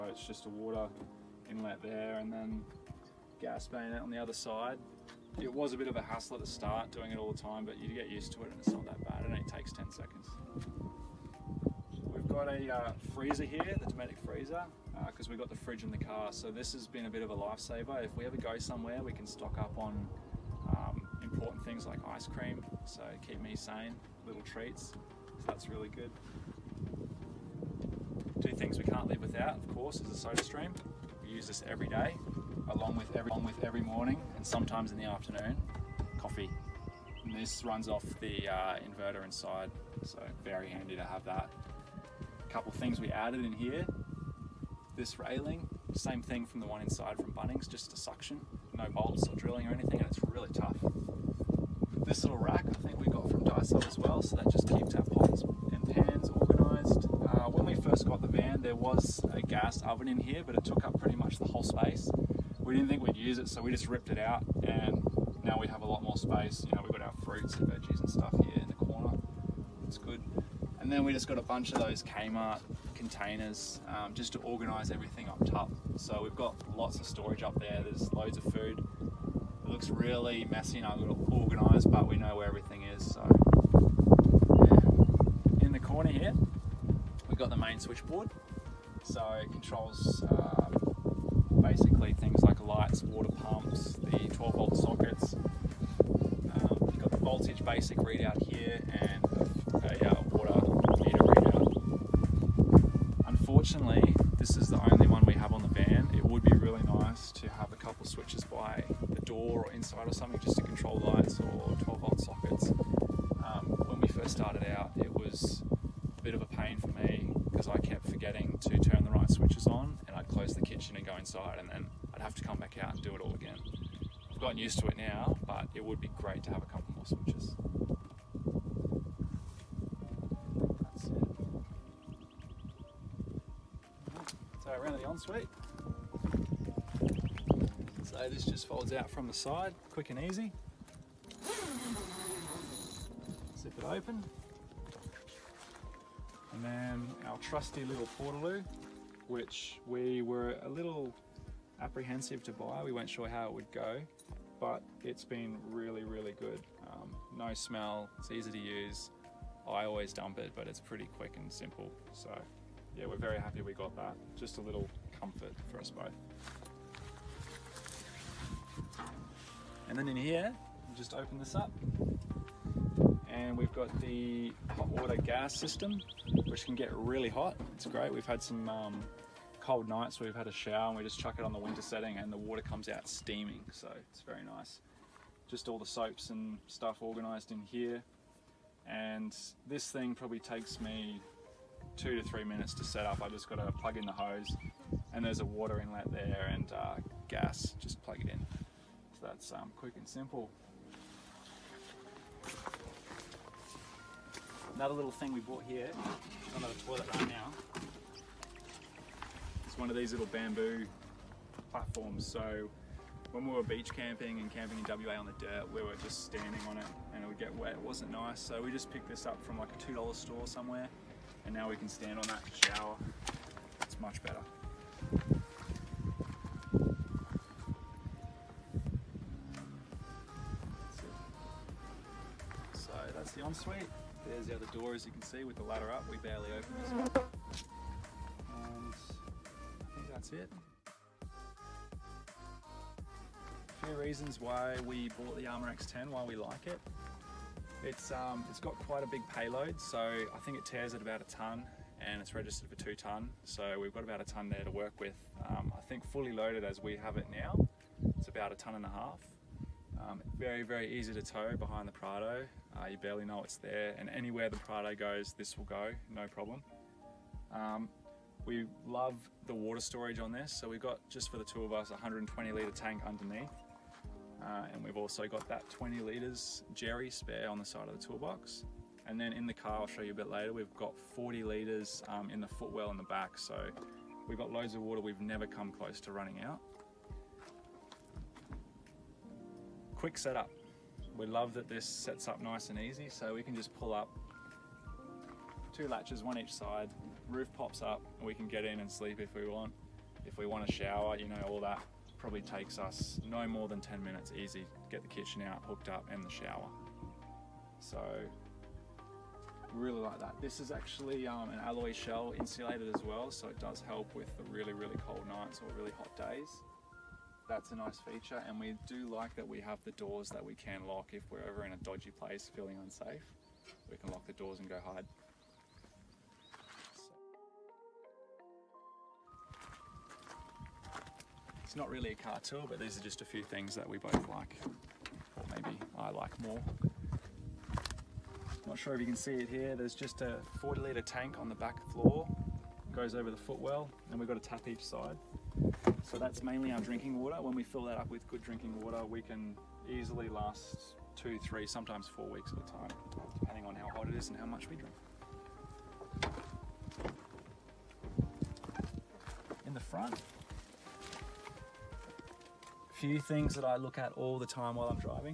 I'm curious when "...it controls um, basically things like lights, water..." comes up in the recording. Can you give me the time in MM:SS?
01:29.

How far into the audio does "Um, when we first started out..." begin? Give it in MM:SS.
01:52.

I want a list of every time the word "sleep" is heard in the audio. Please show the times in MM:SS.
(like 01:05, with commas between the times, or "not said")
04:58.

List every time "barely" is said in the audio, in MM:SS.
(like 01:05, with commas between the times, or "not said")
03:56, 04:22.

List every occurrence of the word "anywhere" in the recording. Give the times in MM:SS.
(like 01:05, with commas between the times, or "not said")
04:24.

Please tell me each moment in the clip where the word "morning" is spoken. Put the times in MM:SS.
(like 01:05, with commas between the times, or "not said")
00:33.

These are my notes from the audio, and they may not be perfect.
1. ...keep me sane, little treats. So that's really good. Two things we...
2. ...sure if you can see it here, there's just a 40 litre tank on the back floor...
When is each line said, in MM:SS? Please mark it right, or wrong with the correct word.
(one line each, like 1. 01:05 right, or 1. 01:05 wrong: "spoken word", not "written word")
1. 00:23 right
2. 05:38 right.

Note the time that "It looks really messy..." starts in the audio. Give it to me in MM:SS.
01:19.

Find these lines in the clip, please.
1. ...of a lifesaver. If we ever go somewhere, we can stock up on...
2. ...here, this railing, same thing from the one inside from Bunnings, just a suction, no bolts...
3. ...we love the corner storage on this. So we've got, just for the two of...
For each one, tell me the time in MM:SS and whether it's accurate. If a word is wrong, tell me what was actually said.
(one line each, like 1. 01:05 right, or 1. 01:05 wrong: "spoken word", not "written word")
1. 00:17 right
2. 00:43 right
3. 04:28 wrong: "water", not "corner".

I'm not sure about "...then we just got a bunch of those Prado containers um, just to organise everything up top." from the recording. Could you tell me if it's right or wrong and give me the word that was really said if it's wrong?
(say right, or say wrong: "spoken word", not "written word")
wrong: "Kmart", not "Prado".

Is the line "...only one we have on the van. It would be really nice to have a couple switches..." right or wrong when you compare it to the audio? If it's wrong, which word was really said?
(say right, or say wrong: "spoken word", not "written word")
right.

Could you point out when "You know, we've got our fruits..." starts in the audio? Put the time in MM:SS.
01:06.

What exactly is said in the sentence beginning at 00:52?
This little rack I think we got from Daiso as well, so that just keeps our pots organised.